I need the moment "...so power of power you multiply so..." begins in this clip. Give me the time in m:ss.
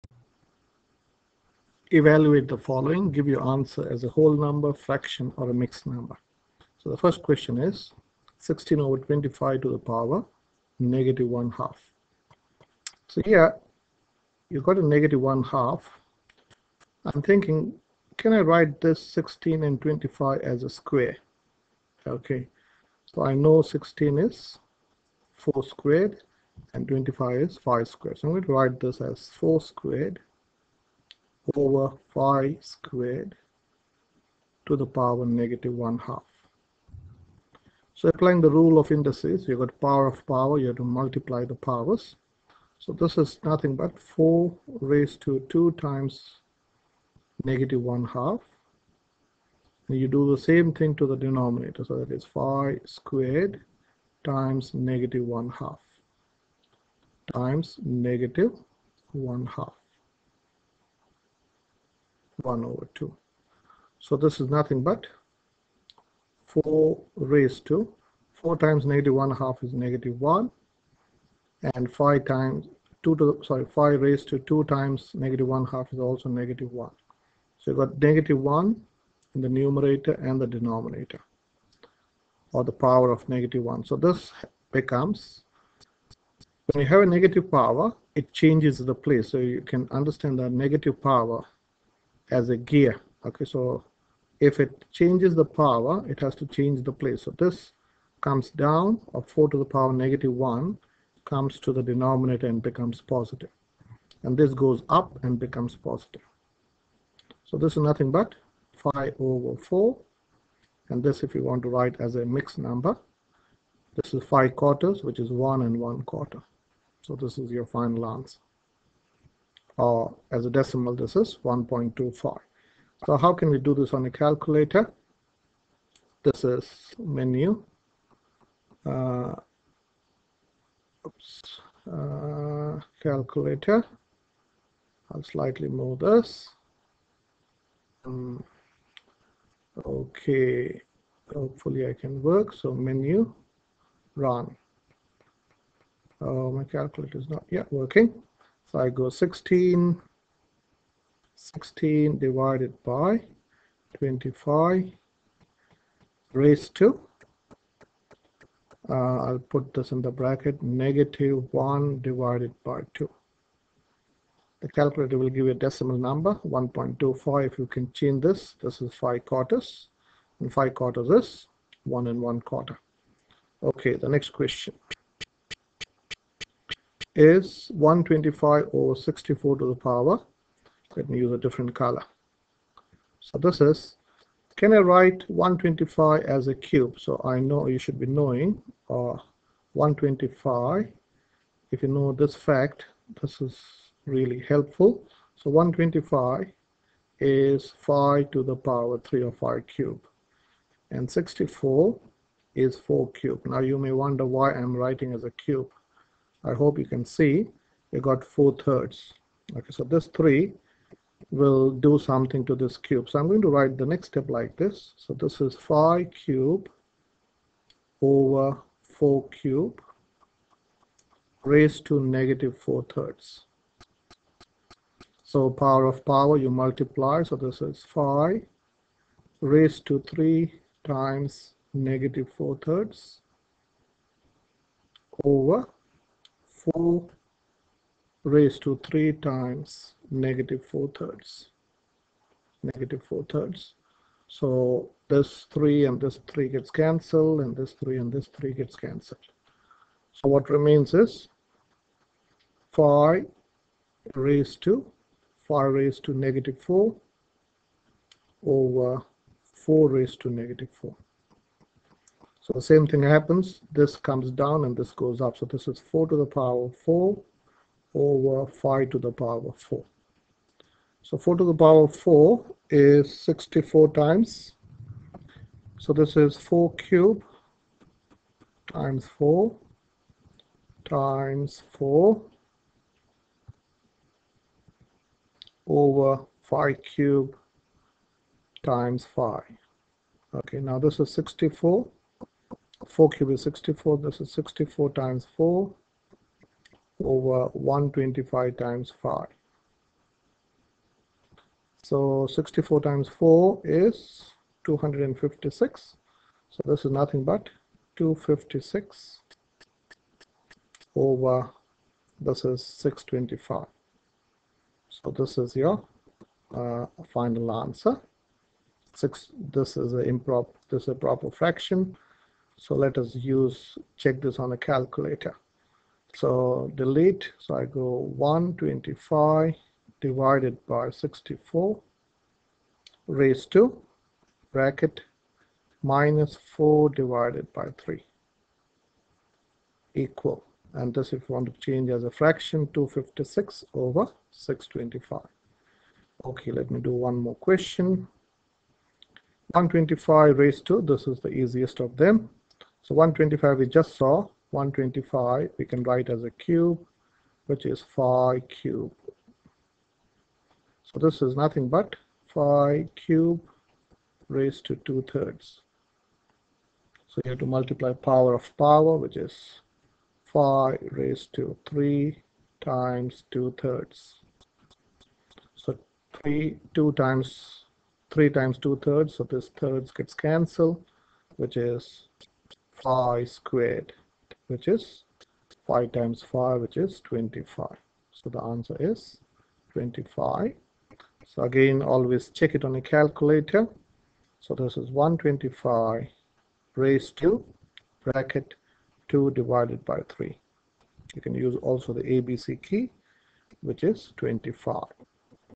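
3:45.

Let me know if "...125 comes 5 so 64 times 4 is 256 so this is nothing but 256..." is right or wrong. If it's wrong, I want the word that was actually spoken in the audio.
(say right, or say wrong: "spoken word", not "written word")
wrong: "times", not "comes".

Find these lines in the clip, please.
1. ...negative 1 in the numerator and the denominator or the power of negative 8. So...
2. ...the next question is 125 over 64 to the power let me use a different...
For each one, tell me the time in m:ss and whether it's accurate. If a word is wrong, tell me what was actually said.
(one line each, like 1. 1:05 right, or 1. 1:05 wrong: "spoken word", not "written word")
1. 1:18 wrong: "1", not "8"
2. 2:53 right.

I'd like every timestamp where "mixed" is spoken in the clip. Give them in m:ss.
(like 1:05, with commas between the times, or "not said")
0:05, 1:52.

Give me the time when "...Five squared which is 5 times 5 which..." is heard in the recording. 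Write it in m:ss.
6:22.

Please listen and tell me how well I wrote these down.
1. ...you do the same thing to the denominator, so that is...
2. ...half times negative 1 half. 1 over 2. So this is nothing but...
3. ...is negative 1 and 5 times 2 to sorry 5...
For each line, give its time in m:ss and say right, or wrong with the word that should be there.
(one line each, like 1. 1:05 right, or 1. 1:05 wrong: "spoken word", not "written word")
1. 0:49 right
2. 0:55 right
3. 1:09 right.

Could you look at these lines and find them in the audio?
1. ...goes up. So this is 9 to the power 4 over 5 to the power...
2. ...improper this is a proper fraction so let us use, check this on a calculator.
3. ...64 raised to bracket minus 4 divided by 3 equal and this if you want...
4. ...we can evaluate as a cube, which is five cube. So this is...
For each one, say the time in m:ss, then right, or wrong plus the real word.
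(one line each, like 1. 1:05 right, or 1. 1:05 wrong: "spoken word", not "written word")
1. 4:24 wrong: "4", not "9"
2. 5:19 right
3. 5:30 right
4. 5:55 wrong: "write", not "evaluate".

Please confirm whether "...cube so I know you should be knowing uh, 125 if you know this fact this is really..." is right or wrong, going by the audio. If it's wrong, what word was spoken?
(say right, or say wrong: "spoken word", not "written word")
right.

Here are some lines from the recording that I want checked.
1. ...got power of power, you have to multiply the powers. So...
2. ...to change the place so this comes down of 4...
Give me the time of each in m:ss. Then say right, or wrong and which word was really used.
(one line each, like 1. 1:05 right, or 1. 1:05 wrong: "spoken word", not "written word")
1. 0:39 right
2. 1:36 right.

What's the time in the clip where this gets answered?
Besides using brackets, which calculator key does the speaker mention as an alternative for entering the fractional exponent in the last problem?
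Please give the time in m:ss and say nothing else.
6:42.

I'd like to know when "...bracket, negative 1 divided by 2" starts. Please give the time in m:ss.
2:40.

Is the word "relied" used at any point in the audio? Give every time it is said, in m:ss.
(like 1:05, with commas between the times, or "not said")
not said.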